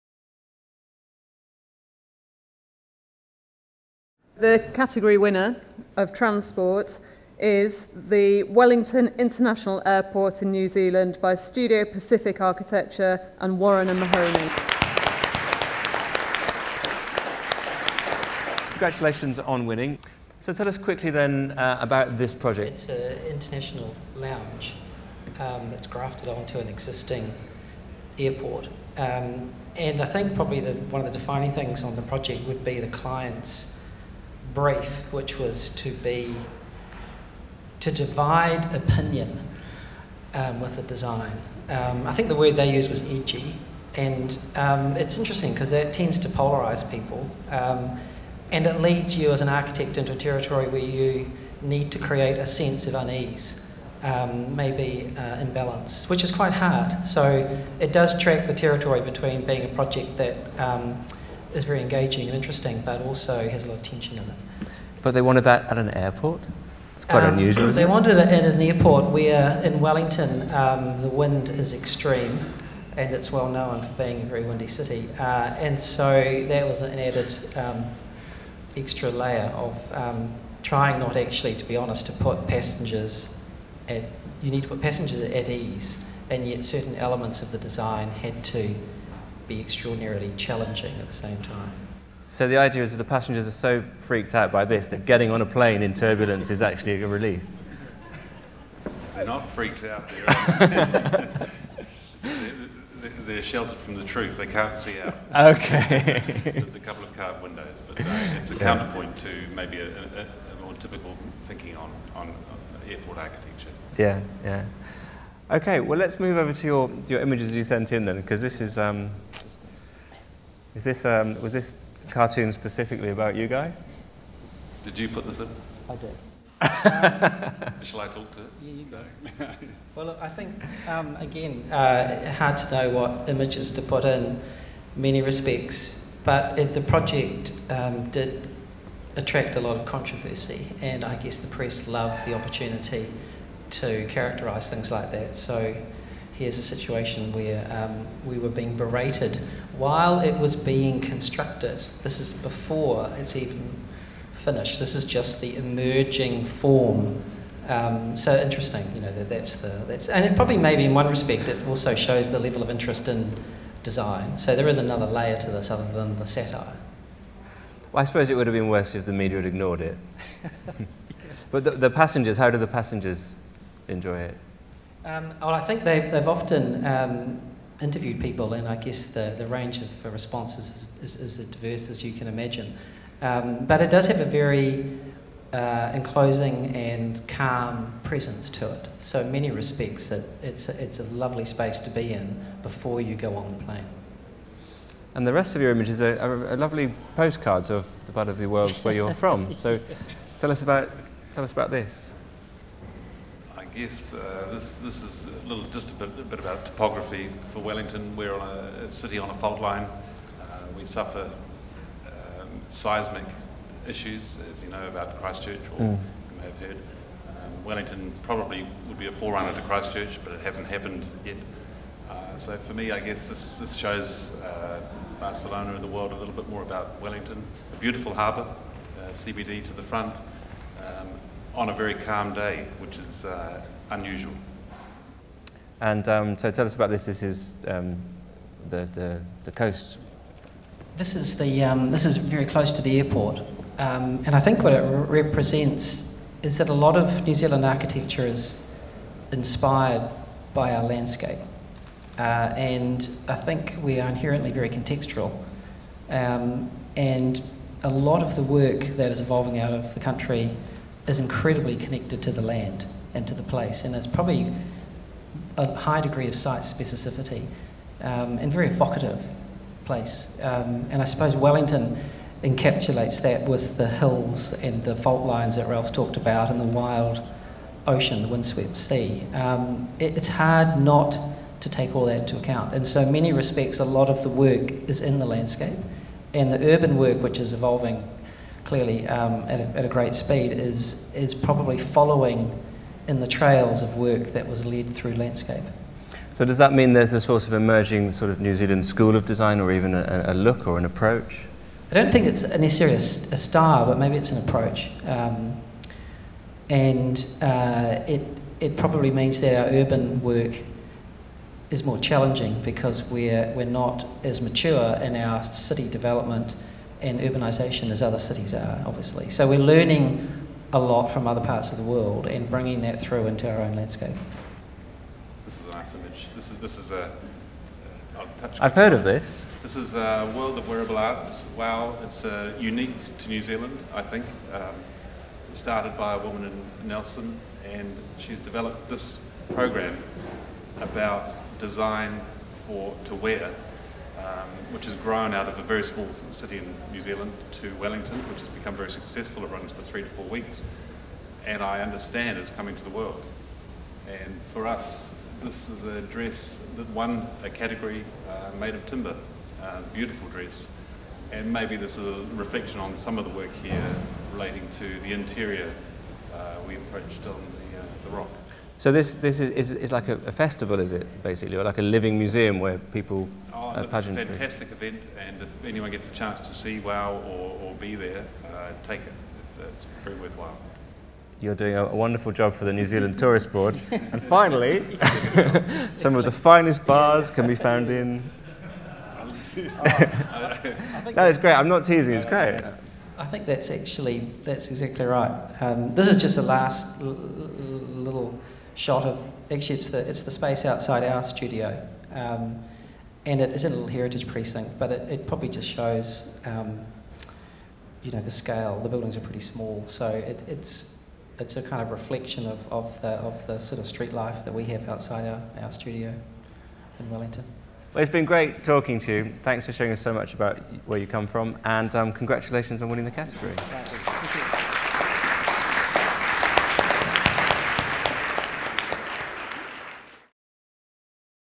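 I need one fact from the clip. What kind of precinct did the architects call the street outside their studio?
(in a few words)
Heritage precinct.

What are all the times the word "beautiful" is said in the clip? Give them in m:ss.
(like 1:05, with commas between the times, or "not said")
3:47, 5:59.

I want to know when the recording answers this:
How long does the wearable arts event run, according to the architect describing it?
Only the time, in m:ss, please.
5:49.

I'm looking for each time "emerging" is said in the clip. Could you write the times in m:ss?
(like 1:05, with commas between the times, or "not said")
2:35, 4:57.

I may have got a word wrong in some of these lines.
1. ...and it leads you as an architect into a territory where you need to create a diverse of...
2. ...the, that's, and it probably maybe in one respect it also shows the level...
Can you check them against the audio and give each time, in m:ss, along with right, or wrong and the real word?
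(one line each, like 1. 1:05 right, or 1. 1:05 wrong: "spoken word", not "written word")
1. 0:48 wrong: "sense", not "diverse"
2. 2:39 right.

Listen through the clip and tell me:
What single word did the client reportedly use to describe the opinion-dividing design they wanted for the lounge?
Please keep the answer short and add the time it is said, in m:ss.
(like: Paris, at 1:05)
Edgy, at 0:43.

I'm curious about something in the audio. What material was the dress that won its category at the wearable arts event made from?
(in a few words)
Timber.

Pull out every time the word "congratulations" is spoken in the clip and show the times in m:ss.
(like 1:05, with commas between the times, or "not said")
0:18, 7:02.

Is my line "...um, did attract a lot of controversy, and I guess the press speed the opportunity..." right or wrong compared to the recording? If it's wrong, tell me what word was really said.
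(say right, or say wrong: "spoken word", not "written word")
wrong: "loved", not "speed".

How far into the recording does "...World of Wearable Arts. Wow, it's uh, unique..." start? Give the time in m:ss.
5:30.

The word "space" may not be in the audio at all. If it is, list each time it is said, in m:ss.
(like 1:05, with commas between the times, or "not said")
3:11, 6:40.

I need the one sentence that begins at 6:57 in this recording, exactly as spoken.
Well, it's been great talking to you.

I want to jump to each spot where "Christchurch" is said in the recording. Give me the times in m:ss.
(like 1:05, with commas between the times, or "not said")
3:35, 3:39.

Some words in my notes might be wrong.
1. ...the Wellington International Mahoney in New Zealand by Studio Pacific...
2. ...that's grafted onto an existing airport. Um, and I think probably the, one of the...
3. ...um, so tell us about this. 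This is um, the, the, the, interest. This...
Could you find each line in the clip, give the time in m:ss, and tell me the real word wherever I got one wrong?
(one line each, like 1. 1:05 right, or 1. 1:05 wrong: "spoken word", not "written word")
1. 0:08 wrong: "Airport", not "Mahoney"
2. 0:25 right
3. 3:56 wrong: "coast", not "interest".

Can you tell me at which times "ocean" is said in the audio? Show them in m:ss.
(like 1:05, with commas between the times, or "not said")
4:37.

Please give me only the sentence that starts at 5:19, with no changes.
So we're learning a lot from other parts of the world and bringing that through into our own landscape.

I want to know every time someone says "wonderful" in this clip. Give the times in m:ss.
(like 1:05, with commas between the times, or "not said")
6:21.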